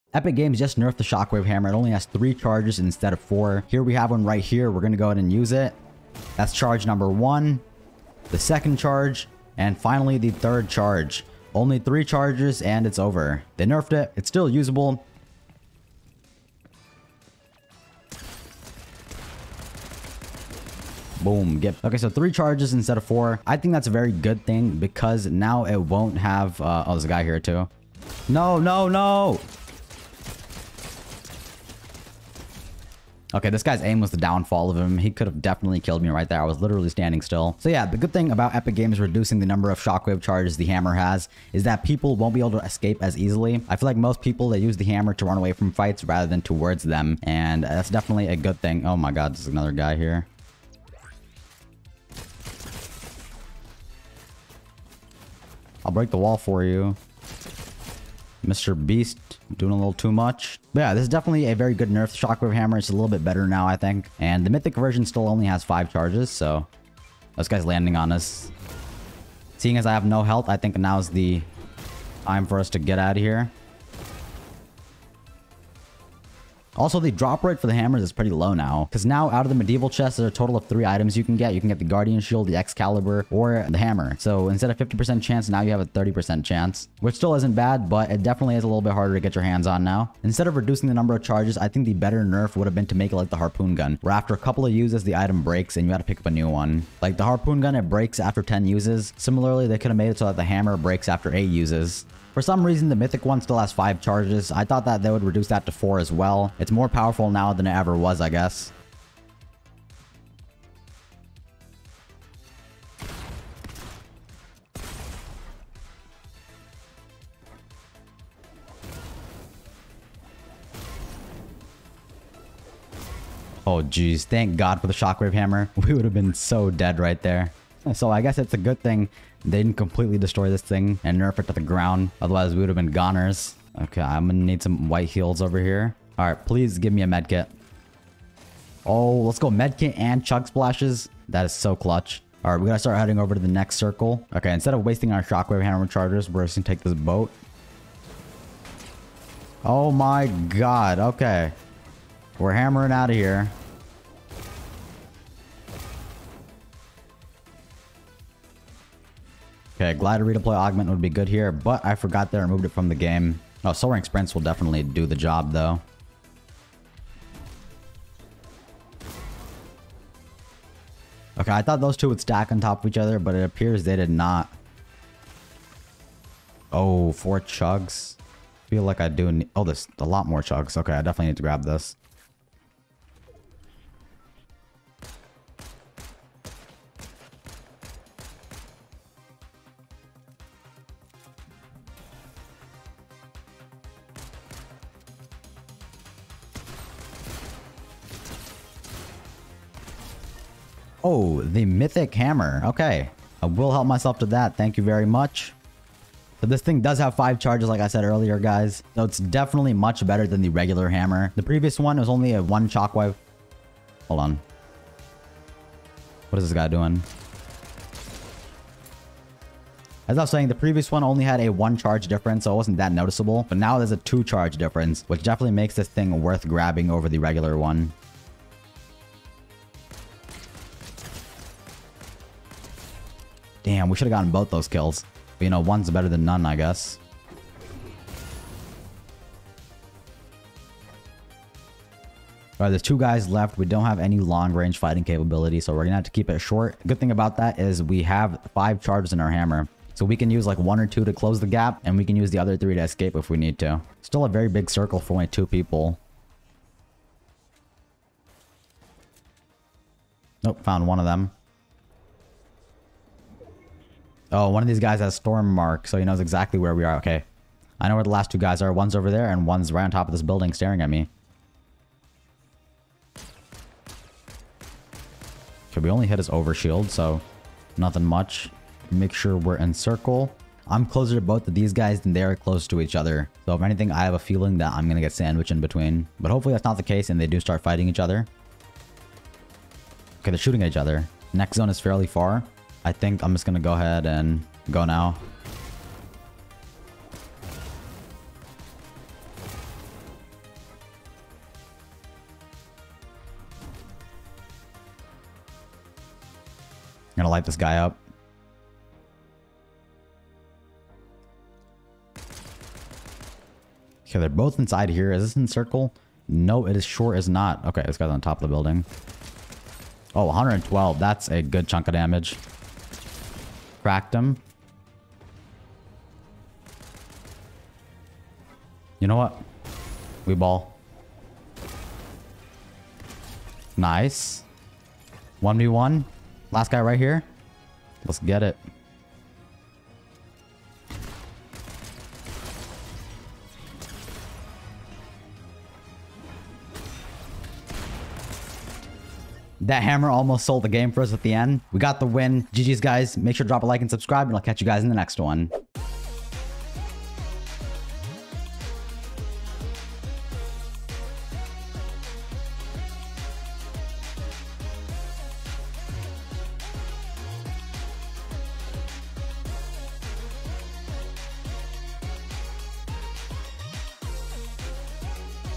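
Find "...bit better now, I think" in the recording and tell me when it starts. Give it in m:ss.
1:03.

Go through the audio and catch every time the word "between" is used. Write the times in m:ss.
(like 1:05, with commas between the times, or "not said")
4:45.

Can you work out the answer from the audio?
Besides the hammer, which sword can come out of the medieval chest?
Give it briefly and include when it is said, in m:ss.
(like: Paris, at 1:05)
Excalibur, at 1:22.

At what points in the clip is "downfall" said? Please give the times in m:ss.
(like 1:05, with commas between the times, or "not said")
0:34.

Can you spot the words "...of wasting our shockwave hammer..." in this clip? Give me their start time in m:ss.
2:24.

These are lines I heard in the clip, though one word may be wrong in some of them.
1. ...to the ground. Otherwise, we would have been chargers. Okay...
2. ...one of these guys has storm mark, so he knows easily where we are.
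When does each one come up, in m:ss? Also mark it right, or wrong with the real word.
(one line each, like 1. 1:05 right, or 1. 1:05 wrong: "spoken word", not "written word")
1. 2:11 wrong: "goners", not "chargers"
2. 4:24 wrong: "exactly", not "easily".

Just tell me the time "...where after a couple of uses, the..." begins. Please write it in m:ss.
1:34.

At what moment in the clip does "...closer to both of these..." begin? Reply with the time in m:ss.
4:40.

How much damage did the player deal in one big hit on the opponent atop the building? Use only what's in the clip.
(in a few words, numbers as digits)
112.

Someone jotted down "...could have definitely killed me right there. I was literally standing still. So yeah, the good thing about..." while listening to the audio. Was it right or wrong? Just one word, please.
right.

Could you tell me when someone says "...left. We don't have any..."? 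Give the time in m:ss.
4:03.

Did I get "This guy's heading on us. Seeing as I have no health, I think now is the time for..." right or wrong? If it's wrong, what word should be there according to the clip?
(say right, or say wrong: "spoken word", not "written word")
wrong: "landing", not "heading".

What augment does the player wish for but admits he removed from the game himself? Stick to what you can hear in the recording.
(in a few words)
Glad to Redeploy.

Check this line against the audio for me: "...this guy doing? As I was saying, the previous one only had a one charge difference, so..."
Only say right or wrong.
right.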